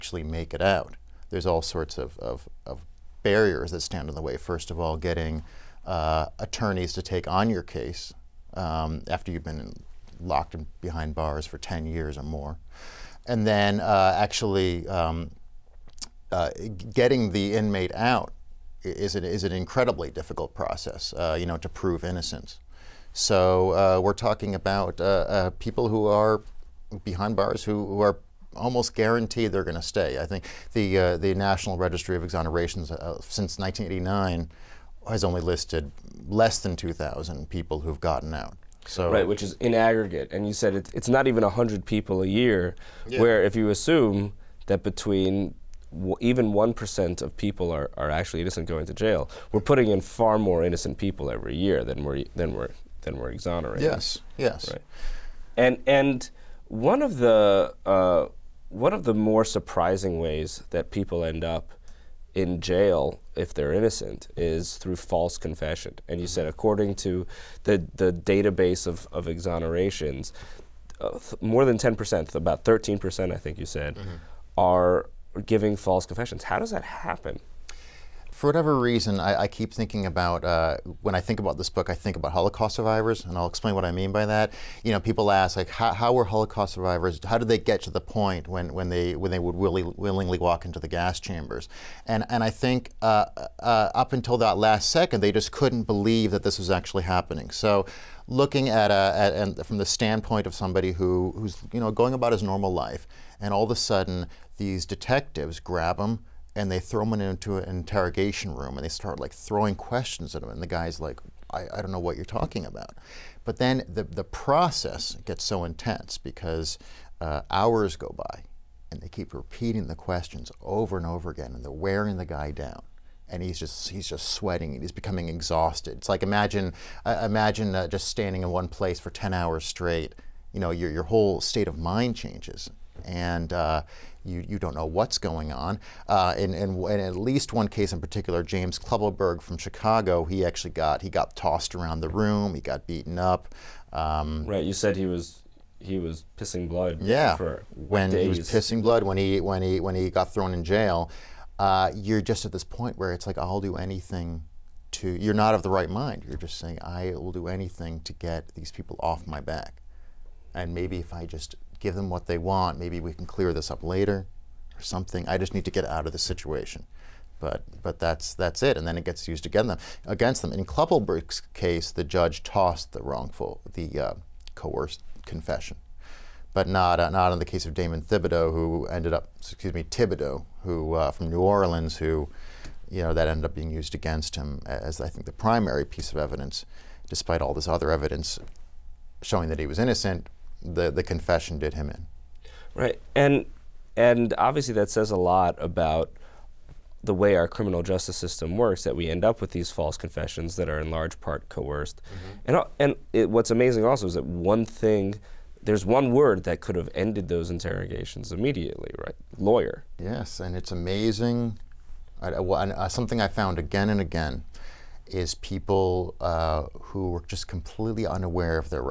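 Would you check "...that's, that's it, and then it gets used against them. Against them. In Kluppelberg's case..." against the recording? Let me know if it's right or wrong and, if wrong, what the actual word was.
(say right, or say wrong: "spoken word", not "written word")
right.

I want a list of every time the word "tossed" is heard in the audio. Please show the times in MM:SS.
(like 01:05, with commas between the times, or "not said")
02:21, 02:52.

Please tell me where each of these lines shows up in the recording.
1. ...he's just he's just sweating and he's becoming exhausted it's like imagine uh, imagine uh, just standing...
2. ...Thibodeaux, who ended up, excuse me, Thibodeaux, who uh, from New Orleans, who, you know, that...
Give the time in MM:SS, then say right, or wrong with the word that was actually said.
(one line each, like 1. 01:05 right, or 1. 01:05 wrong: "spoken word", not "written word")
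1. 02:03 right
2. 02:58 right.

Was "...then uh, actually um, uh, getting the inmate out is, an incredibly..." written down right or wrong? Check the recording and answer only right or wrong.
right.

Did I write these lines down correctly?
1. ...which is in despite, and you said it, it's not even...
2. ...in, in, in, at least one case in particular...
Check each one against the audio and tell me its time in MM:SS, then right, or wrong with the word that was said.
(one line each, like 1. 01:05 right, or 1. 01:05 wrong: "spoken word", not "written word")
1. 00:39 wrong: "aggregate", not "despite"
2. 02:16 right.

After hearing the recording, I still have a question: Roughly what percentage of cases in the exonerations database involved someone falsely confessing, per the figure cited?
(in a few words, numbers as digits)
13%.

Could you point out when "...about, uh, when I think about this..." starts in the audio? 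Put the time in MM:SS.
01:20.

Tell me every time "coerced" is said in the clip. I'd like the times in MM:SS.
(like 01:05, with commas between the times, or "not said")
02:54, 03:21.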